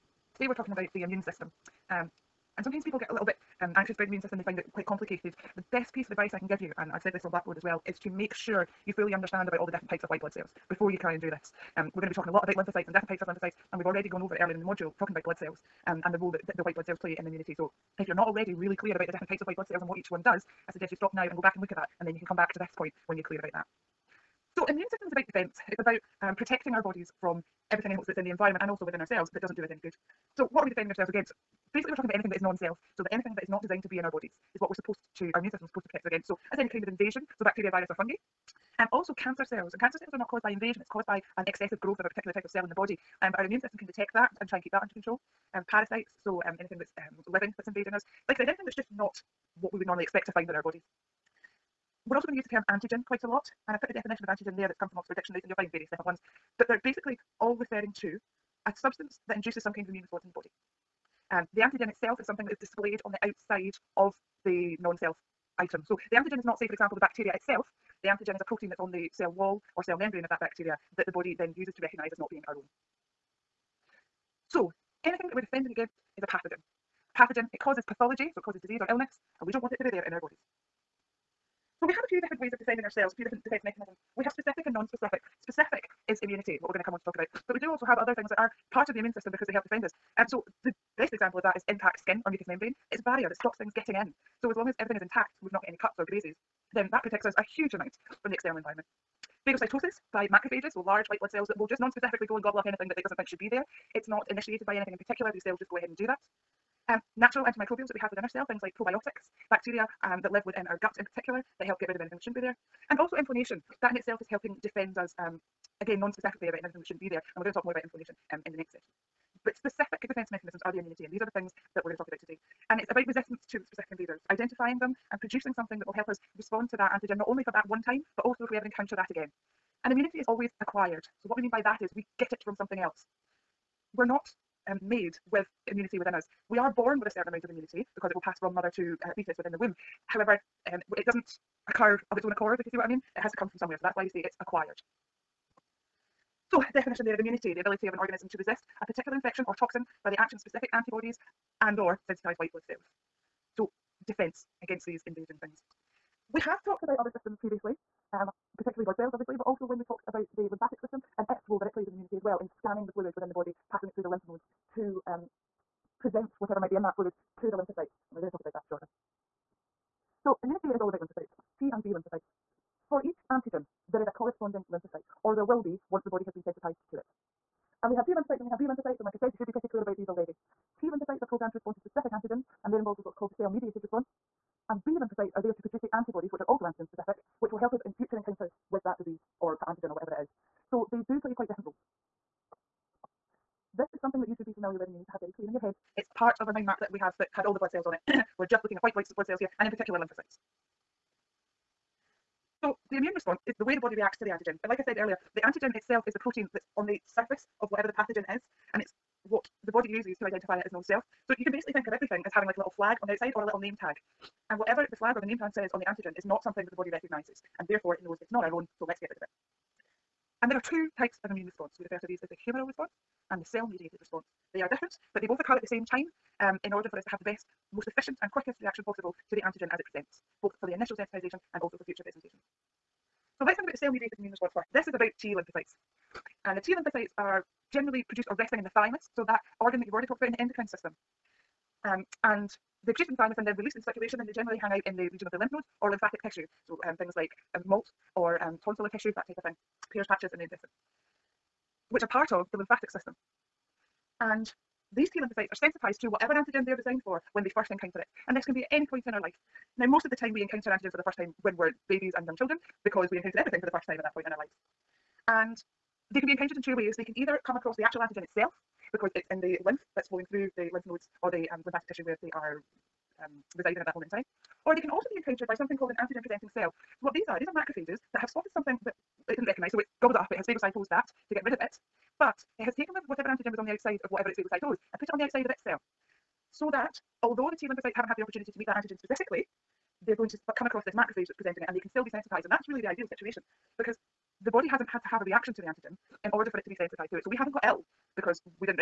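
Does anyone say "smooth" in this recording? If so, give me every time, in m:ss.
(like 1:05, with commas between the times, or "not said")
not said.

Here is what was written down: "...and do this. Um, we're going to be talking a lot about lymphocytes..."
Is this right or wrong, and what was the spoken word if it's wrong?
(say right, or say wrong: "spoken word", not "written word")
right.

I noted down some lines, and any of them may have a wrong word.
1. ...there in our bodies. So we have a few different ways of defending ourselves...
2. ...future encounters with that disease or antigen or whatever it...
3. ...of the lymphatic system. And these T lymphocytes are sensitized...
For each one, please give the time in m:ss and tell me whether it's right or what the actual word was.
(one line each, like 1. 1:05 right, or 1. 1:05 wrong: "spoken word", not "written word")
1. 1:19 right
2. 3:07 right
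3. 4:12 right.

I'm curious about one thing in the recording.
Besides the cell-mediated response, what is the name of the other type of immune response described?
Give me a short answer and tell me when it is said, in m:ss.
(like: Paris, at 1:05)
humoral response, at 3:42.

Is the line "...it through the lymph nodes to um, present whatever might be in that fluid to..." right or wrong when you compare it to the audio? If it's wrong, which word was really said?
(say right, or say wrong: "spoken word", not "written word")
right.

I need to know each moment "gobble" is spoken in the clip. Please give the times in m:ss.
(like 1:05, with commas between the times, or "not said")
1:42, 4:40.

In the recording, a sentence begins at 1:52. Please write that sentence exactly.
And also inflammation, that in itself is helping defend us, um, again, non-specifically about anything that shouldn't be there.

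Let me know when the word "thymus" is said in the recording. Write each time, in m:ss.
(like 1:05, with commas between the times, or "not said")
3:58, 4:03.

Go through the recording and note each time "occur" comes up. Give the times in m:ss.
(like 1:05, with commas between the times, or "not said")
2:21, 3:45.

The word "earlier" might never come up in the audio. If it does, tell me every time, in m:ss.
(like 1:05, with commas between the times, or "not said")
0:14, 3:24.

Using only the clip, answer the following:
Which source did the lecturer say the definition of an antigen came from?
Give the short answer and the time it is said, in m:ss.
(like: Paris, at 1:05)
Oxford dictionaries, at 0:54.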